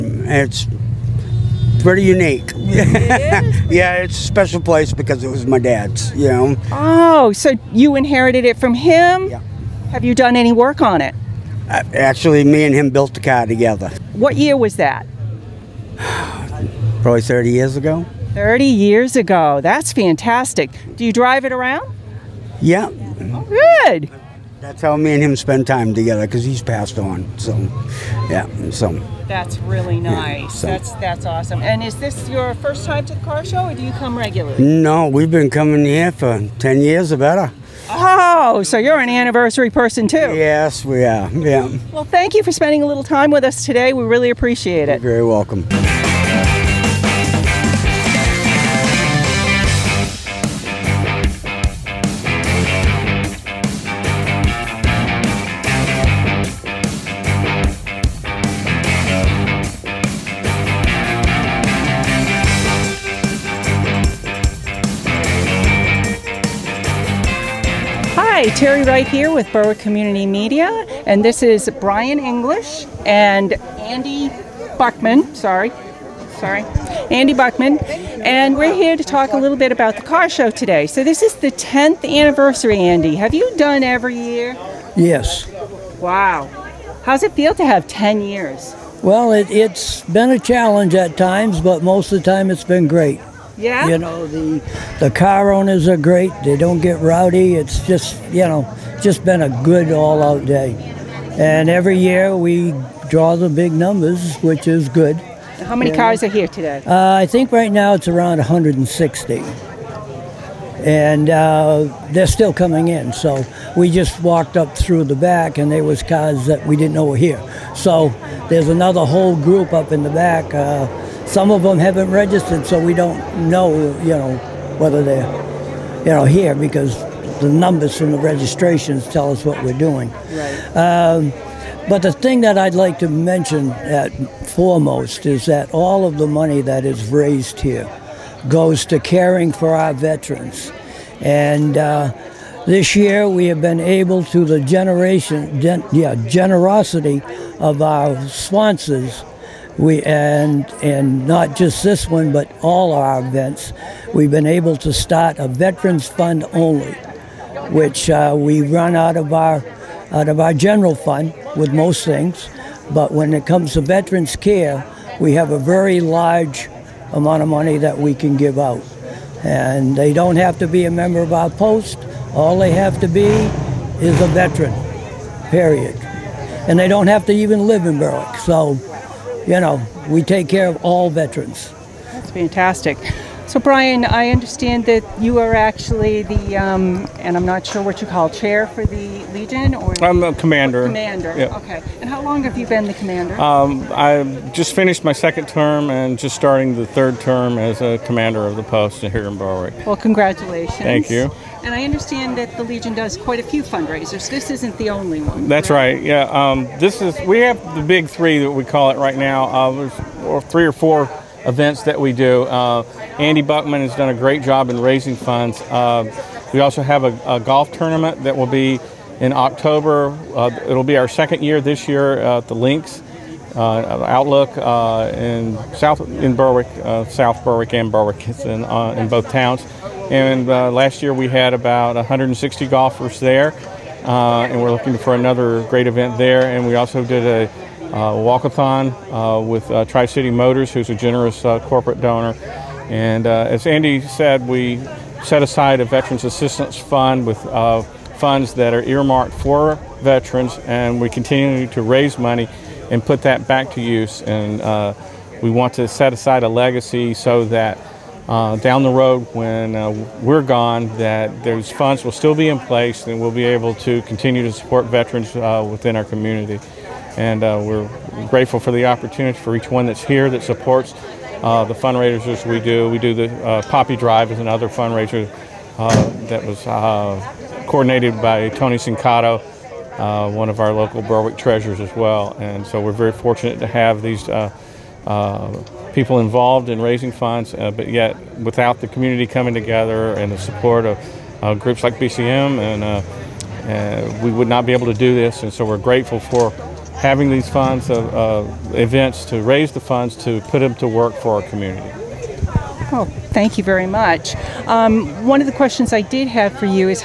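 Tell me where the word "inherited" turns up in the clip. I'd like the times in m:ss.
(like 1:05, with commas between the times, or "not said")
0:07.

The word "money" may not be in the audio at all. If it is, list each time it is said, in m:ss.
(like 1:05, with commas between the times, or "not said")
2:16, 2:47, 4:12.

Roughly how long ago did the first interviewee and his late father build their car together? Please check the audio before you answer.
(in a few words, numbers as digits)
30 years ago.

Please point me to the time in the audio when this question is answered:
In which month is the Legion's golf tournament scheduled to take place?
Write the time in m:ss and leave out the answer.
3:39.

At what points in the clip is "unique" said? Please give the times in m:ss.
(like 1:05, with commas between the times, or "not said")
0:02.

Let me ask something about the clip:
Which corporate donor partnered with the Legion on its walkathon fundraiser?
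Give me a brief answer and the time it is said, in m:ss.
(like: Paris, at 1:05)
Tri City Motors, at 3:59.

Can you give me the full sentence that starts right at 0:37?
Oh, so you're an anniversary person too?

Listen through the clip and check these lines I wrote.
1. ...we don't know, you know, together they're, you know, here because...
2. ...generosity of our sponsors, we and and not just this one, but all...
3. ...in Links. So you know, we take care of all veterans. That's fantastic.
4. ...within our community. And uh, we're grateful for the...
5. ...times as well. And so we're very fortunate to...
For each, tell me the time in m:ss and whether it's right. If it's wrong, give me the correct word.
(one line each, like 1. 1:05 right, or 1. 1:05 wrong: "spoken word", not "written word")
1. 2:02 wrong: "whether", not "together"
2. 2:26 right
3. 2:57 wrong: "Berwick", not "Links"
4. 4:25 right
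5. 4:41 wrong: "treasures", not "times".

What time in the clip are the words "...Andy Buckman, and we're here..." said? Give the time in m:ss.
1:17.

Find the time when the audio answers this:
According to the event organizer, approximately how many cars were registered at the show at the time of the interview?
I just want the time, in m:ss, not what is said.
1:48.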